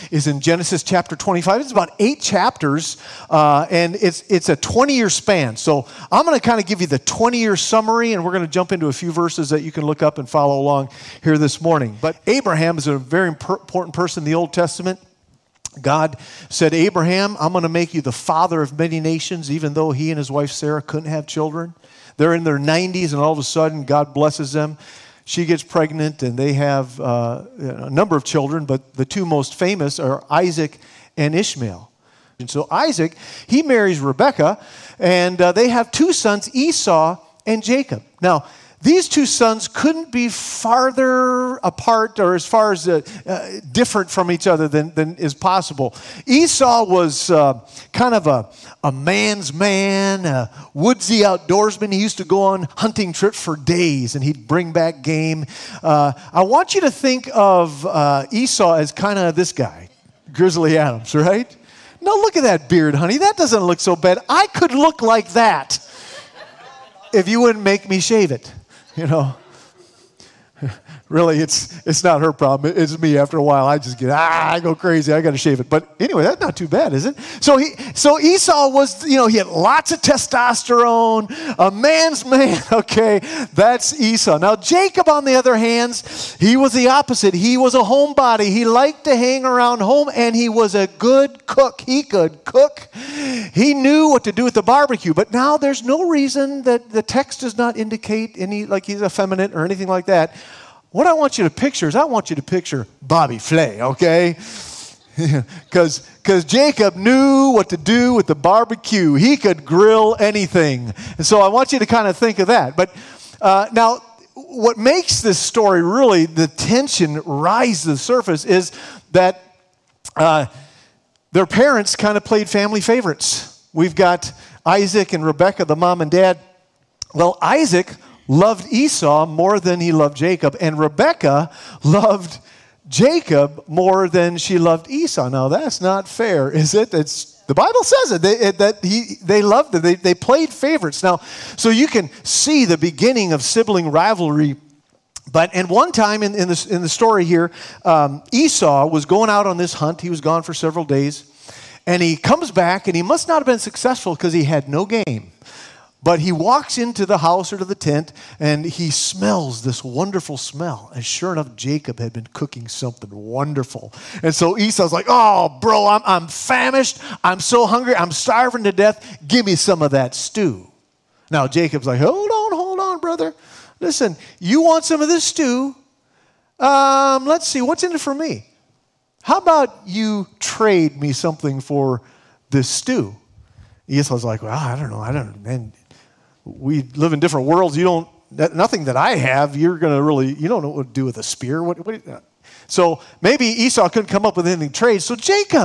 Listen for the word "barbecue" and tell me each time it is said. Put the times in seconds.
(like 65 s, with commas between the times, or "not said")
94 s, 108 s.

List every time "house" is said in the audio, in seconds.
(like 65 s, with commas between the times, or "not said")
157 s.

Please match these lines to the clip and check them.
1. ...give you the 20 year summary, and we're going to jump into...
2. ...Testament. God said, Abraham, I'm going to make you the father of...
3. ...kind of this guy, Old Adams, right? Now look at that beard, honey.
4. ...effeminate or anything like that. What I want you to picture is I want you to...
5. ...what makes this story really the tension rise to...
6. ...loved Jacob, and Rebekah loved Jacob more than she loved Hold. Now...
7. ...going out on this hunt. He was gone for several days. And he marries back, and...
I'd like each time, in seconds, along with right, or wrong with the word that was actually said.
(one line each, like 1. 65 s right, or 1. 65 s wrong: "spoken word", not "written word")
1. 6 s right
2. 14 s right
3. 58 s wrong: "Grizzly", not "Old"
4. 99 s right
5. 114 s right
6. 129 s wrong: "Esau", not "Hold"
7. 149 s wrong: "comes", not "marries".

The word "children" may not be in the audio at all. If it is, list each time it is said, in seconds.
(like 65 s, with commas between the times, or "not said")
21 s, 28 s.